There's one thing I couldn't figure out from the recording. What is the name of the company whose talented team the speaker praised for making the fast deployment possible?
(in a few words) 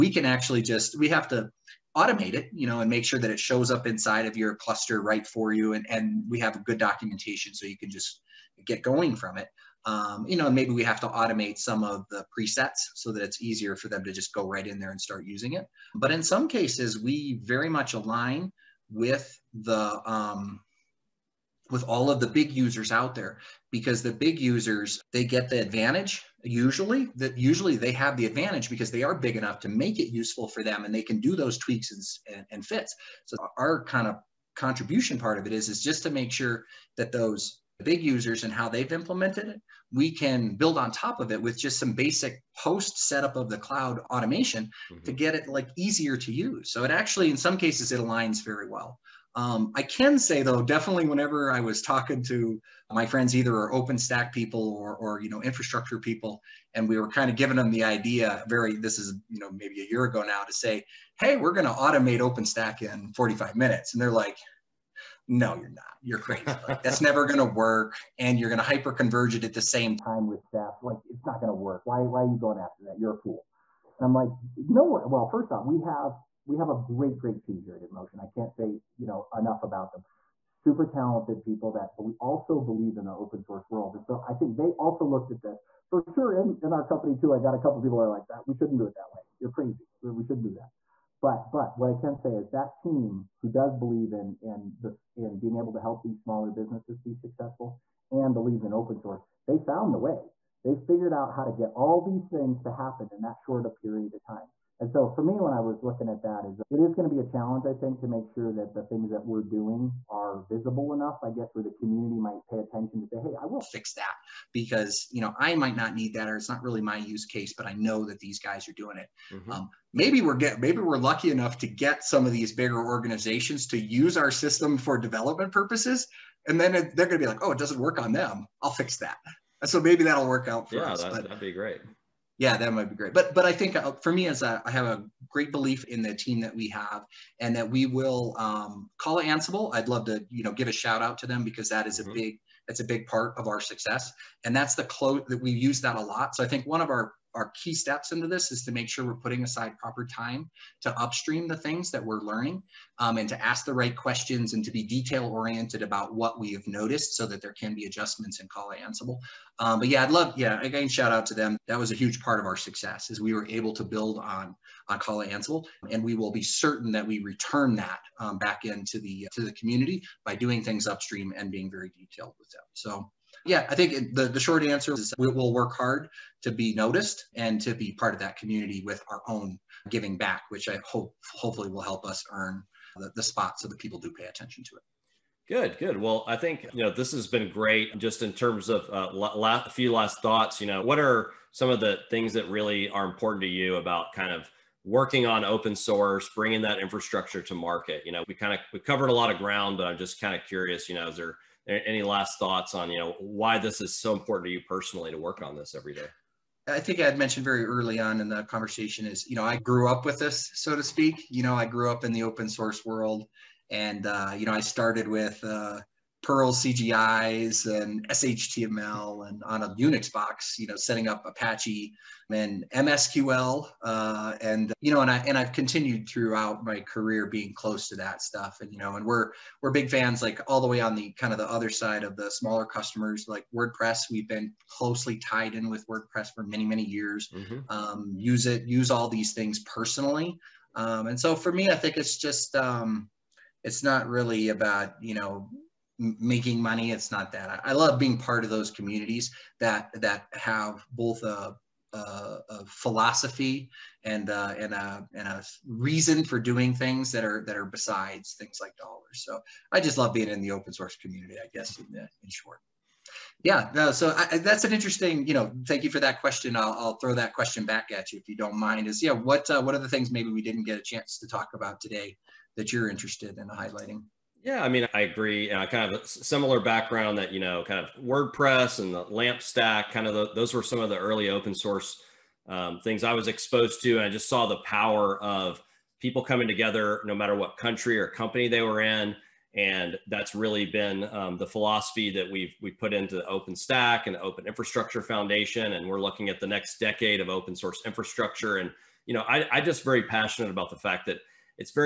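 InMotion.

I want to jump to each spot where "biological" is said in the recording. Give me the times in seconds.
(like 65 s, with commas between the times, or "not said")
not said.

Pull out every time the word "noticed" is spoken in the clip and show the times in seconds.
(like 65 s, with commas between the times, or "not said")
156 s, 176 s.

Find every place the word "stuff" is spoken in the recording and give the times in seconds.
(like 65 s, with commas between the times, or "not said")
228 s.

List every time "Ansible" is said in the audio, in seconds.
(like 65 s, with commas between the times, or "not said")
139 s, 158 s, 165 s.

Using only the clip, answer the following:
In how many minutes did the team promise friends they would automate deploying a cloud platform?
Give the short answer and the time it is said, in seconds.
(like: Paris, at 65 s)
45, at 63 s.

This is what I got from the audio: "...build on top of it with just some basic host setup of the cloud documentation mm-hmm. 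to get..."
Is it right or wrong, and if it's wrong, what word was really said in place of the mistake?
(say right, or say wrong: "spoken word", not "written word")
wrong: "automation", not "documentation".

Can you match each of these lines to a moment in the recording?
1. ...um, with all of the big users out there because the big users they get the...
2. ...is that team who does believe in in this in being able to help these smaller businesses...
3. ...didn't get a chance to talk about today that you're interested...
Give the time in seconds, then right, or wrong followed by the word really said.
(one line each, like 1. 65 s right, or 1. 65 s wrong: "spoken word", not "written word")
1. 20 s right
2. 92 s right
3. 270 s right.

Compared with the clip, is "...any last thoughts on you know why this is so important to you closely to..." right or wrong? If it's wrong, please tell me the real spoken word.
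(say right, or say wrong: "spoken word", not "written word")
wrong: "personally", not "closely".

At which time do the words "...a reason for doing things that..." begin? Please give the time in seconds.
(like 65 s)
255 s.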